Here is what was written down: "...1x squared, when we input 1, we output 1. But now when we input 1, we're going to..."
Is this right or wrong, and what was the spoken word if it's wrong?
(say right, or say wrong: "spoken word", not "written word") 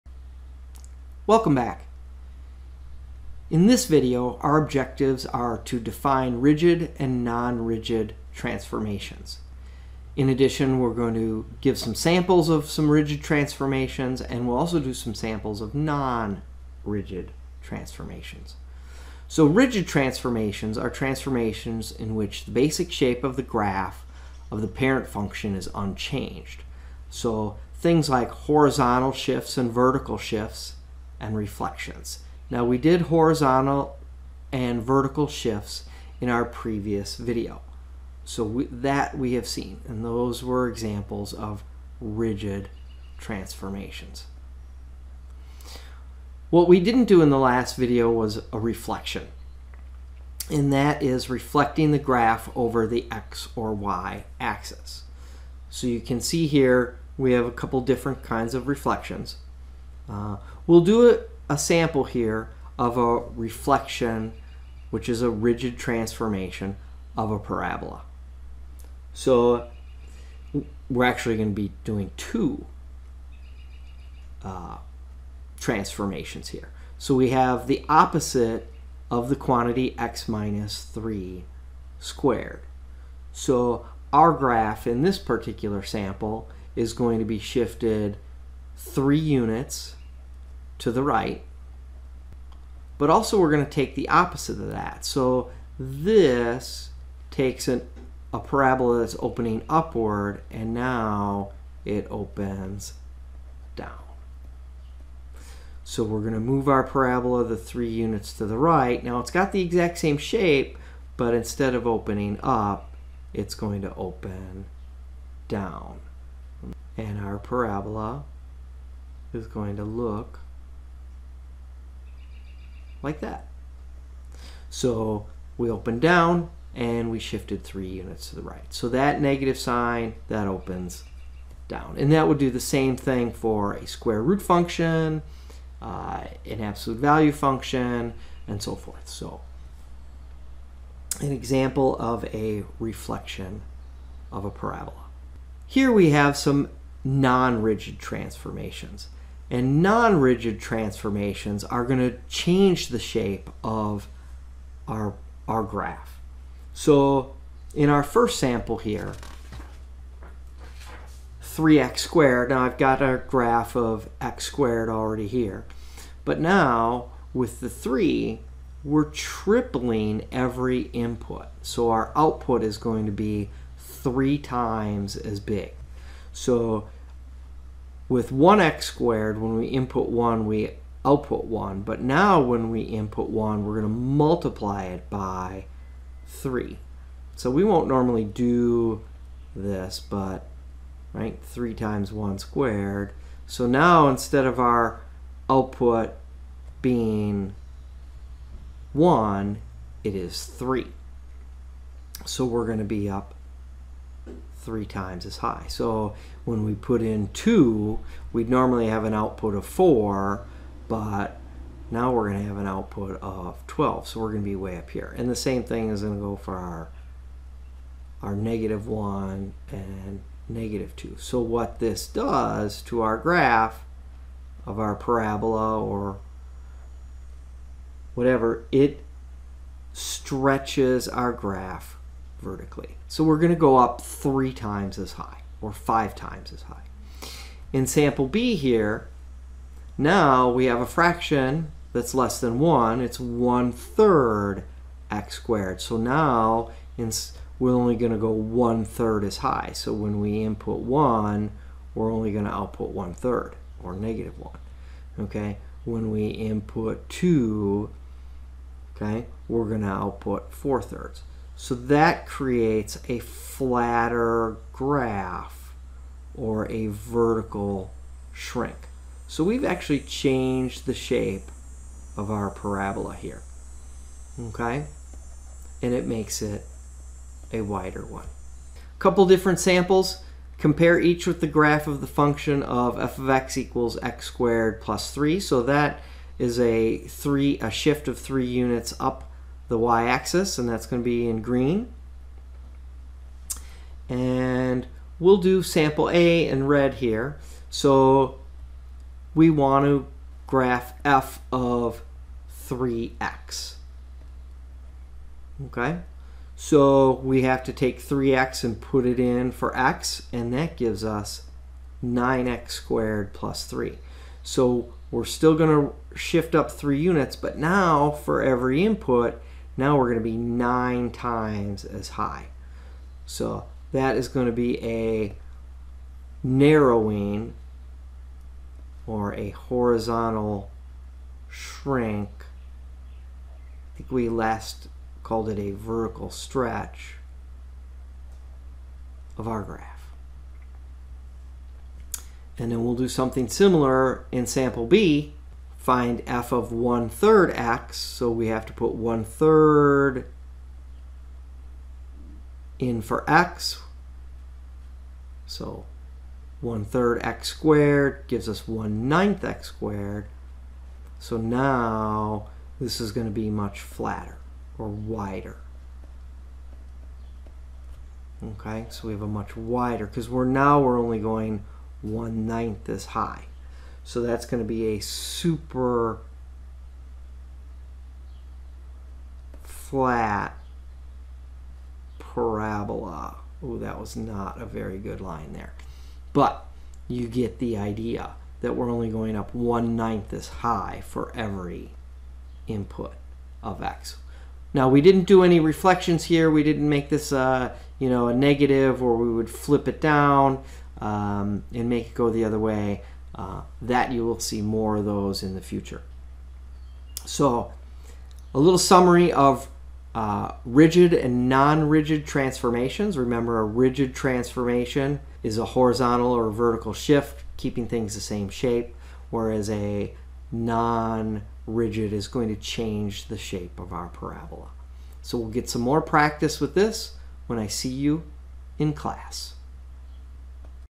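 right.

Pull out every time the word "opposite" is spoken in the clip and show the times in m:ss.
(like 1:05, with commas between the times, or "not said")
1:17, 1:34.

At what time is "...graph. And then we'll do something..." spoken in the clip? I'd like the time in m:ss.
5:39.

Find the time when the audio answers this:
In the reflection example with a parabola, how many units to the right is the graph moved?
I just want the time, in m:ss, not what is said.
1:27.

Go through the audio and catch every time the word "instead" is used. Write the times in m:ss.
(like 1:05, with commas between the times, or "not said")
1:51, 3:14.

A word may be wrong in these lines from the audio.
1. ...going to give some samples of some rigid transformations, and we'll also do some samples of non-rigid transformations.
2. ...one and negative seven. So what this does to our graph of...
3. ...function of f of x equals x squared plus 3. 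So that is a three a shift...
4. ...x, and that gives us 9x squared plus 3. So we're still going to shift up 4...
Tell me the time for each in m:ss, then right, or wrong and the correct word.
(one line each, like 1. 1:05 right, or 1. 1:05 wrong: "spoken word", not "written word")
1. 0:10 right
2. 3:38 wrong: "two", not "seven"
3. 4:42 right
4. 5:09 wrong: "3", not "4".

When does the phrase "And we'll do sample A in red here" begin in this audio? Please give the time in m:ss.
4:54.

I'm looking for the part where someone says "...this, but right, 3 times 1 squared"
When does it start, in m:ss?
3:09.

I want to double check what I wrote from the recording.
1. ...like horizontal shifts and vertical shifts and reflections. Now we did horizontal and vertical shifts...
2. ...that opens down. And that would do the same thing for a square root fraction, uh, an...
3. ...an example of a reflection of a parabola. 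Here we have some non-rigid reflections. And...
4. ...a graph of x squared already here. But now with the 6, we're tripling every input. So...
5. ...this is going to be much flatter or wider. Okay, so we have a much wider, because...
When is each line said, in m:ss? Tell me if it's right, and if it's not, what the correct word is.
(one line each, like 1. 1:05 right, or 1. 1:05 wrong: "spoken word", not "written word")
1. 0:28 right
2. 2:10 wrong: "function", not "fraction"
3. 2:21 wrong: "transformations", not "reflections"
4. 2:43 wrong: "3", not "6"
5. 6:02 right.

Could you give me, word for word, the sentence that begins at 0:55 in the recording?
So you can see here we have a couple different kinds of reflections.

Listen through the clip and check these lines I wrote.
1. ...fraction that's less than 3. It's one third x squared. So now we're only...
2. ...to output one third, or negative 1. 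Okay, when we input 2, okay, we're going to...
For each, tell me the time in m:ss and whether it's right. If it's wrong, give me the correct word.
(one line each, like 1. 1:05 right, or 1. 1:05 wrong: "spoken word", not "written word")
1. 4:00 wrong: "1", not "3"
2. 4:12 right.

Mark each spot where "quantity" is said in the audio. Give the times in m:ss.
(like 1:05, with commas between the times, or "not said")
1:19.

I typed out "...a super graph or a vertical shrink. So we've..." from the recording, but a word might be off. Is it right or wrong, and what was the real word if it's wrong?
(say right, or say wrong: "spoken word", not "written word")
wrong: "flatter", not "super".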